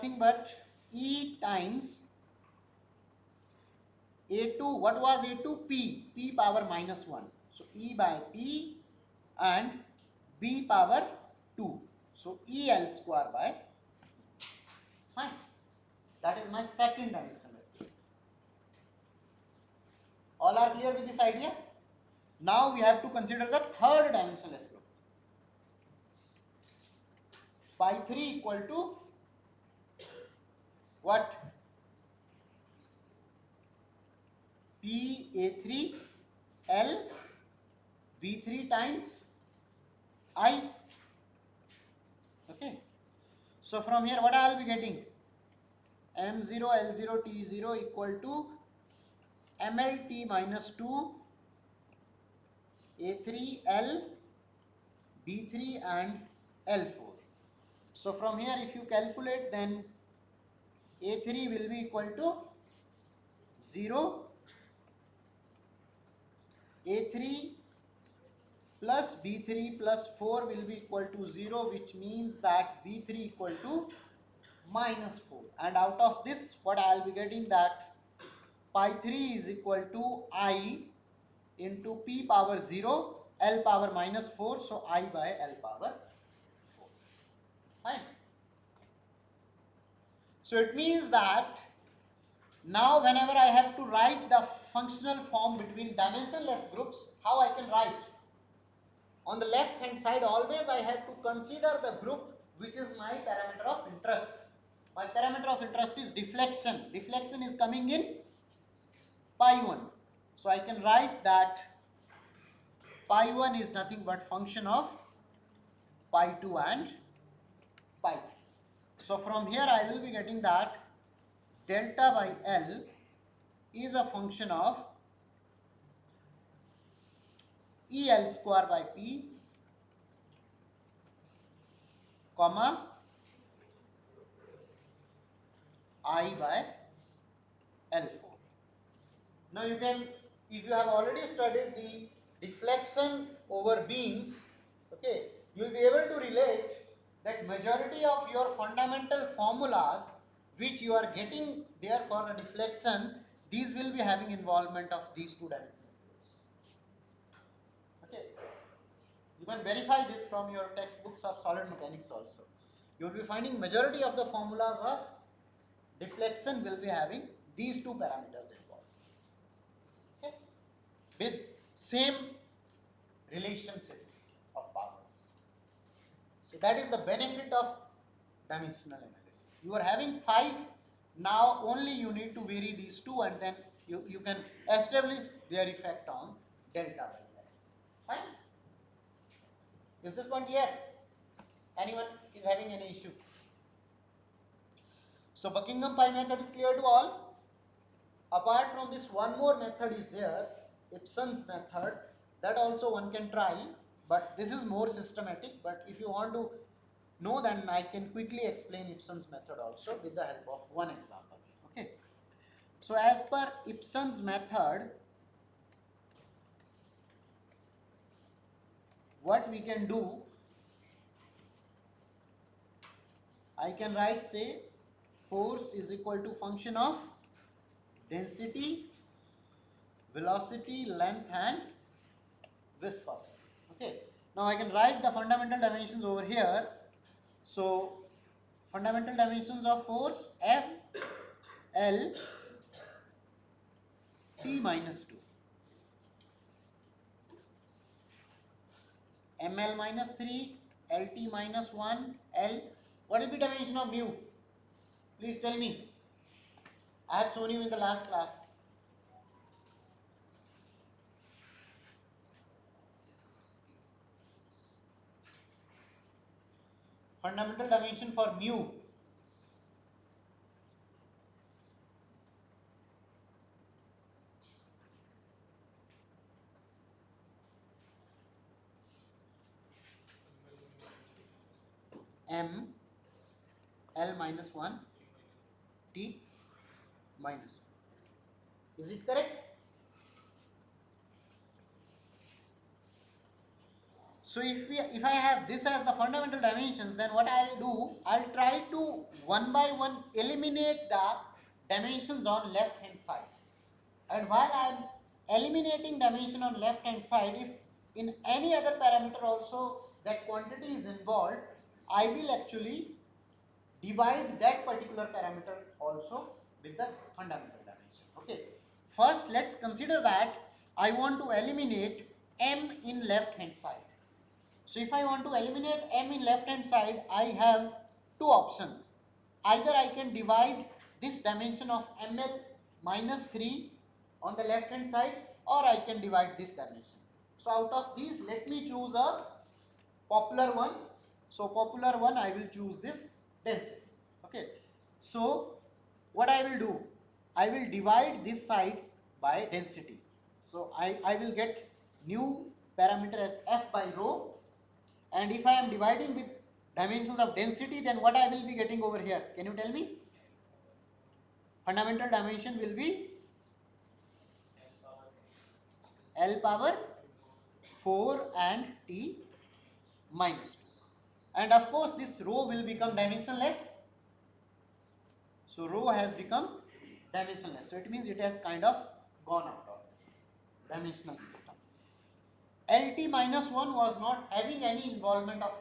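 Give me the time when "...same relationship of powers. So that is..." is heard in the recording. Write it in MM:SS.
02:51.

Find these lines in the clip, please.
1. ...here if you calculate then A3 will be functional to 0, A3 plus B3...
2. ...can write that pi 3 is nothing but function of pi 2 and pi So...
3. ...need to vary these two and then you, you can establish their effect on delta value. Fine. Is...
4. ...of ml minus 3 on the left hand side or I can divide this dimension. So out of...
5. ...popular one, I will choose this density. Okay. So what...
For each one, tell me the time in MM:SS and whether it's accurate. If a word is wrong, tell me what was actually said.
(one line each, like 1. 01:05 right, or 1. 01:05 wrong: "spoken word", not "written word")
1. 00:58 wrong: "equal", not "functional"
2. 01:50 wrong: "1", not "3"
3. 03:02 right
4. 05:31 right
5. 05:41 right.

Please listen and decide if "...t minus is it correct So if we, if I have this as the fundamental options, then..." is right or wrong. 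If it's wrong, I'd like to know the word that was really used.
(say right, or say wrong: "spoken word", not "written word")
wrong: "dimensions", not "options".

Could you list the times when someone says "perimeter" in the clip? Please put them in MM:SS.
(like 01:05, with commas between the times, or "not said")
not said.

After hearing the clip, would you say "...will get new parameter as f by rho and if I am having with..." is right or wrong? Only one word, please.
wrong.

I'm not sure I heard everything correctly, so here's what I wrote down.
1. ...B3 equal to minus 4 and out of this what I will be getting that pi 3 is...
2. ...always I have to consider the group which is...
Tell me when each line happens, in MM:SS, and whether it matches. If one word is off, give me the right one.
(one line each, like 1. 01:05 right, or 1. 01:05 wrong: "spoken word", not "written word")
1. 01:12 right
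2. 01:40 right.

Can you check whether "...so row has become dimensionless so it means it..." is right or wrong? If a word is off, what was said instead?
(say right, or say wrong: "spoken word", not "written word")
right.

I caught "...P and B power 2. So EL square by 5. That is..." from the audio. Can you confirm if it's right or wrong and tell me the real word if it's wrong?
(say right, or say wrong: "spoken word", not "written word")
right.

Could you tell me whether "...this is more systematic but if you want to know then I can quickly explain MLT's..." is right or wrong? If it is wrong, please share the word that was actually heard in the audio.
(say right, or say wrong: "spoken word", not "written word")
wrong: "Ipsen", not "MLT".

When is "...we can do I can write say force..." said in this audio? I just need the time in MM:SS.
03:39.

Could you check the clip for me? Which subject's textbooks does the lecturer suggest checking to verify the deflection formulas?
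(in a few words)
Solid mechanics.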